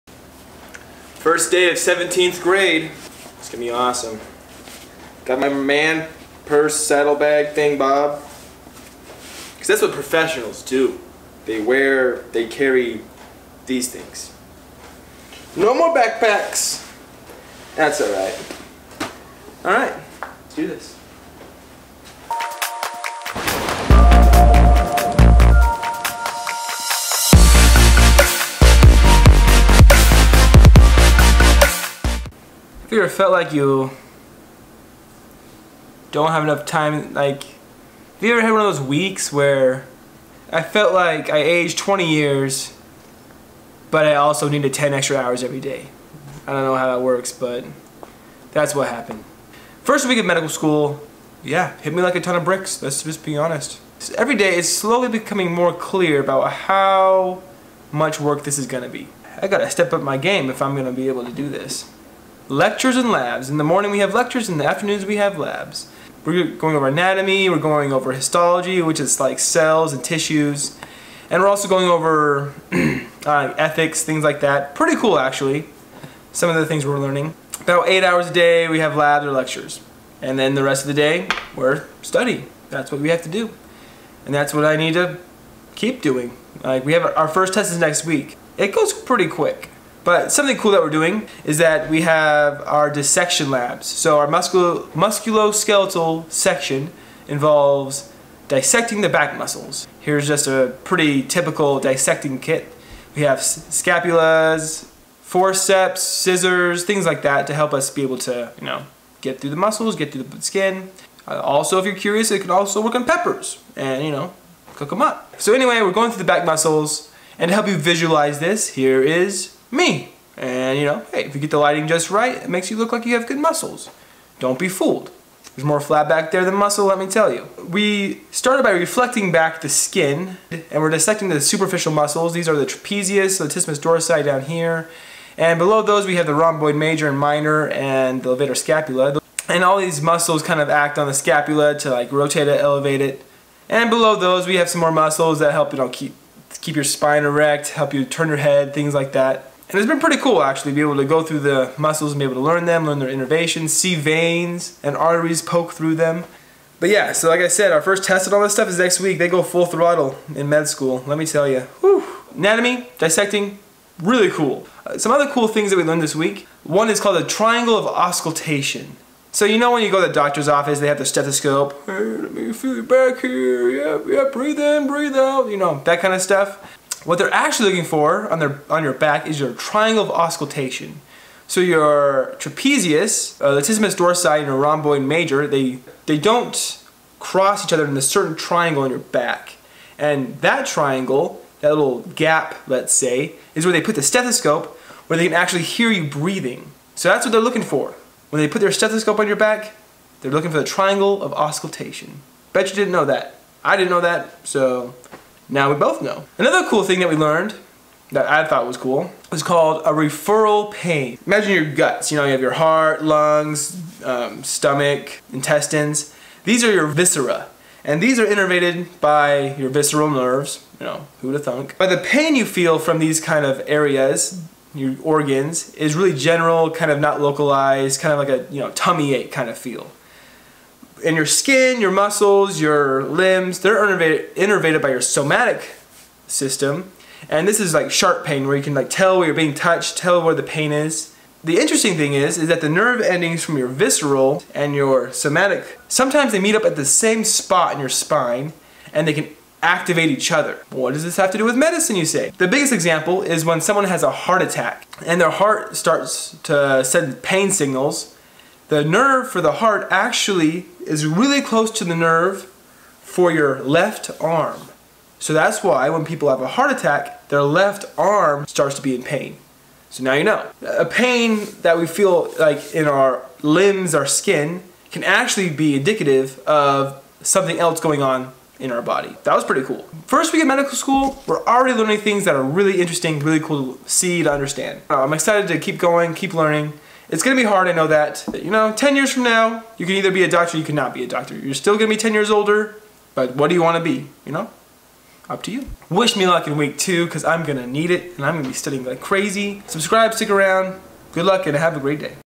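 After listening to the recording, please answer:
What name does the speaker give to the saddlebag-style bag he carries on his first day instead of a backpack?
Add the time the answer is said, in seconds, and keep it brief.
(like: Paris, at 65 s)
Bob, at 7 s.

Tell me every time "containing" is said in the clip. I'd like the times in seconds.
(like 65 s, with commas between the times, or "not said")
not said.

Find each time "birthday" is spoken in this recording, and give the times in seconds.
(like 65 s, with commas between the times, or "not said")
not said.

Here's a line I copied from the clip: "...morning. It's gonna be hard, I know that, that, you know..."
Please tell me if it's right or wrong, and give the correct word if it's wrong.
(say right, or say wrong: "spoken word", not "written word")
wrong: "learning", not "morning".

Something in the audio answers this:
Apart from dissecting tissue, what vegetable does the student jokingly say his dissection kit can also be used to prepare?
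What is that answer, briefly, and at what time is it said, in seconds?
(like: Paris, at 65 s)
Peppers, at 113 s.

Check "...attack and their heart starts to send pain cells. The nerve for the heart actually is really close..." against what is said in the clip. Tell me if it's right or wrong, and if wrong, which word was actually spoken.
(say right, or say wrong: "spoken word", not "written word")
wrong: "signals", not "cells".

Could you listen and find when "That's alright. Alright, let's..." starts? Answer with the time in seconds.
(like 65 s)
17 s.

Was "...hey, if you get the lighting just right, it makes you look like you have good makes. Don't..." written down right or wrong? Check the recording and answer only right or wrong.
wrong.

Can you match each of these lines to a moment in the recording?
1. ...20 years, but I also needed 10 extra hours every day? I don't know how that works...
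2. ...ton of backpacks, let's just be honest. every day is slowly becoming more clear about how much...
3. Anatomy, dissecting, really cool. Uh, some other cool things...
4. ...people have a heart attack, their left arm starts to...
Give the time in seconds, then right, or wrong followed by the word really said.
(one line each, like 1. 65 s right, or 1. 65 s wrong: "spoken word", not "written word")
1. 41 s right
2. 52 s wrong: "bricks", not "backpacks"
3. 162 s right
4. 266 s right.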